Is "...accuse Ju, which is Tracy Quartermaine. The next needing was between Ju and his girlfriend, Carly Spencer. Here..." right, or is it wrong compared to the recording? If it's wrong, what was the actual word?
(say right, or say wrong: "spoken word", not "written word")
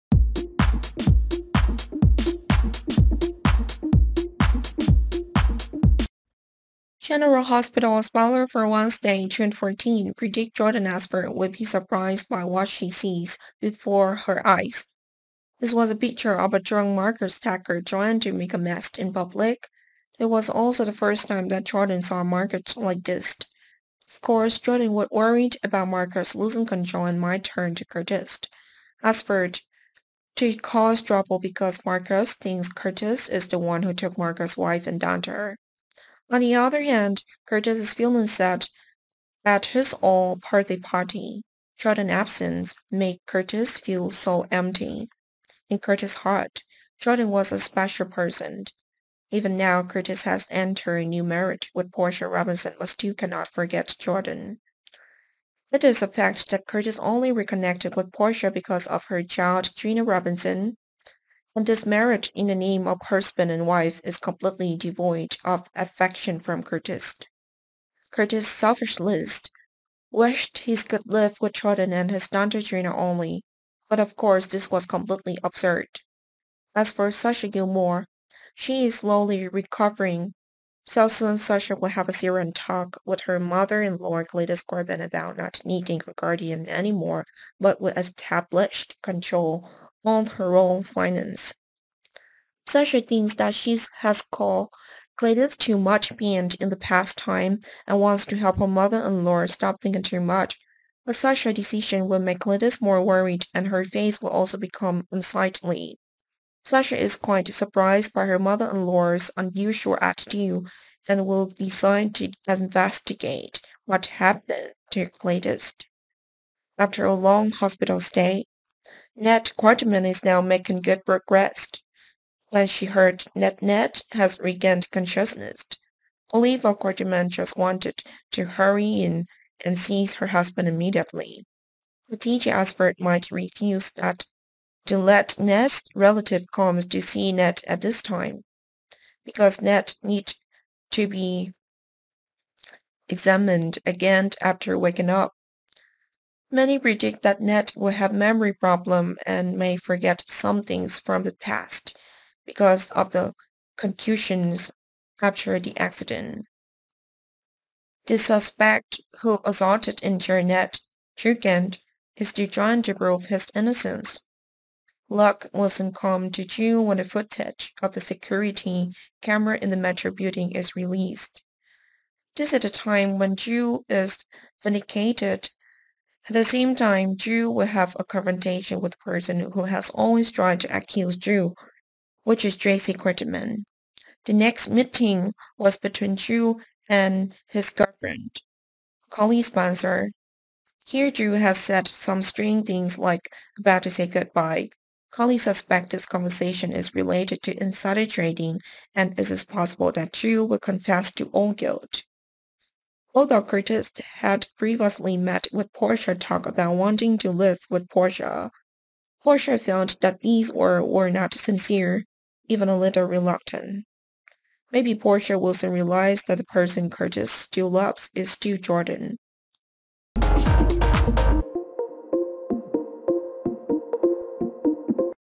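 wrong: "meeting", not "needing".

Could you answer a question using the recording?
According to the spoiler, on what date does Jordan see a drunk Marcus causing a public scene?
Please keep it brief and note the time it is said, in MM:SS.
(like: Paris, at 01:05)
Wednesday, June 14, at 00:08.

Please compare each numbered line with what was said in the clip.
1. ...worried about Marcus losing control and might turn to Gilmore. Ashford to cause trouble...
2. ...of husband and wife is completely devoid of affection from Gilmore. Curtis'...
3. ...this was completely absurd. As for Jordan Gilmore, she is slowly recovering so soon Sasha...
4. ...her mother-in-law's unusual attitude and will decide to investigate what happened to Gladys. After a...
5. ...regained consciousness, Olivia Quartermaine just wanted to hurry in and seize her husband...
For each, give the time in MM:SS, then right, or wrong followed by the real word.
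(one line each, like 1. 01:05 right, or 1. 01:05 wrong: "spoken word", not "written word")
1. 00:25 wrong: "Curtis", not "Gilmore"
2. 01:02 wrong: "Curtis", not "Gilmore"
3. 01:14 wrong: "Sasha", not "Jordan"
4. 01:48 right
5. 02:04 right.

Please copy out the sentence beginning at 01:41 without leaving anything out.
But such a decision will make Gladys more worried and her face will also become unsightly.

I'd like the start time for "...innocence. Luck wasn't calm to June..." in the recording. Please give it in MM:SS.
02:43.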